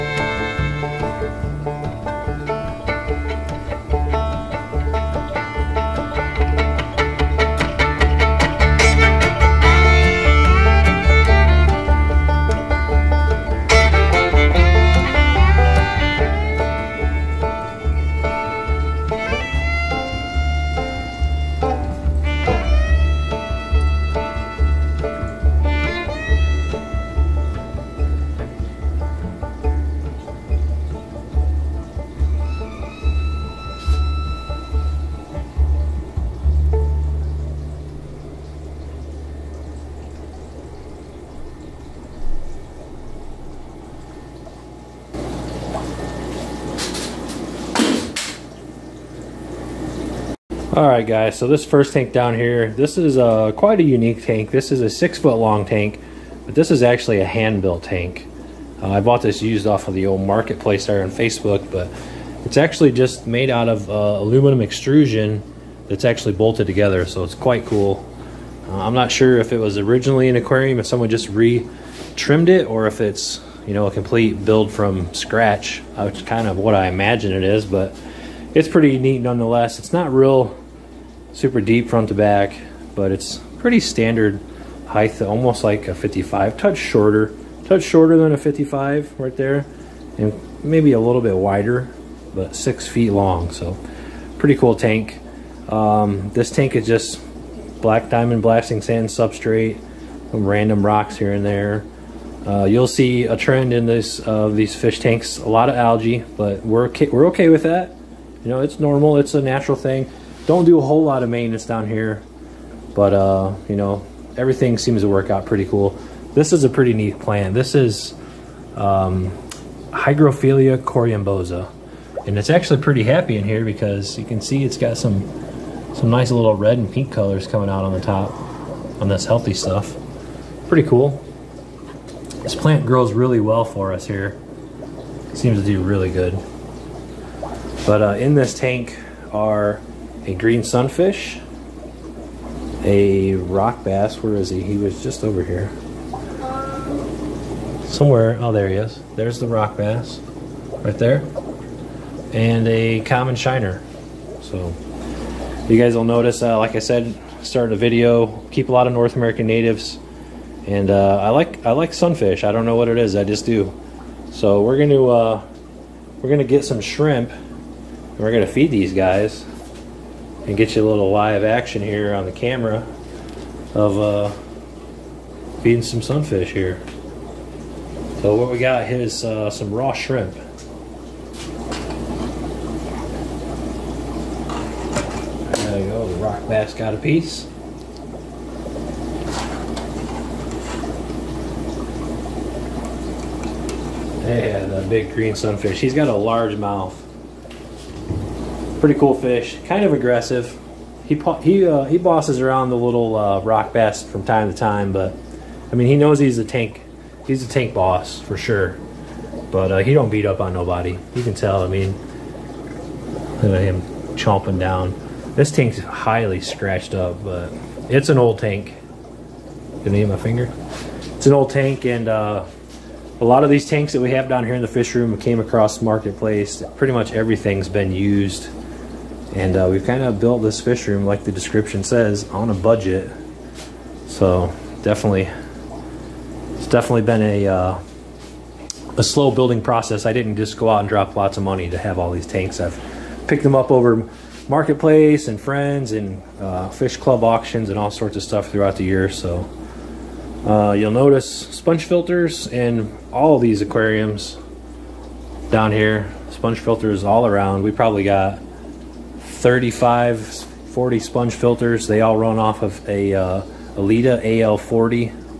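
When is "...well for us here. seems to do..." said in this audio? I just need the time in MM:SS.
02:13.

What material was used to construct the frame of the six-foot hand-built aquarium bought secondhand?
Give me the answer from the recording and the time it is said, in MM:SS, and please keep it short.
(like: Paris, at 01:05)
Aluminum extrusion, at 01:03.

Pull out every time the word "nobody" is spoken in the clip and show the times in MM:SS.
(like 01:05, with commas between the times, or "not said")
03:30.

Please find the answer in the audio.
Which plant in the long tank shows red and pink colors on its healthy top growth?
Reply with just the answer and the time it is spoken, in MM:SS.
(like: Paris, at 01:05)
Hygrophilia corymbosa, at 01:59.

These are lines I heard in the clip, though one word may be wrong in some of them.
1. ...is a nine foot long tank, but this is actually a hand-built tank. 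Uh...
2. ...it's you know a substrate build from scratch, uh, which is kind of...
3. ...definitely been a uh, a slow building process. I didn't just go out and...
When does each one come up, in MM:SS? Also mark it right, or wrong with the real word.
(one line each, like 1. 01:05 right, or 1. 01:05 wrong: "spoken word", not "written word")
1. 00:54 wrong: "six", not "nine"
2. 01:12 wrong: "complete", not "substrate"
3. 03:56 right.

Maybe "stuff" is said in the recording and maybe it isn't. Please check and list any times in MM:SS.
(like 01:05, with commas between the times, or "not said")
02:09, 04:08.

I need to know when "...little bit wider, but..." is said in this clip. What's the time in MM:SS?
01:30.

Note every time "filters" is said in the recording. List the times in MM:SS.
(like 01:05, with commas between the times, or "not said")
04:11, 04:16, 04:21.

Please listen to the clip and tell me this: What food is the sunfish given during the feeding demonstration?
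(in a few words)
Raw shrimp.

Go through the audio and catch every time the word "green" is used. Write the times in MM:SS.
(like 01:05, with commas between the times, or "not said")
02:20, 03:15.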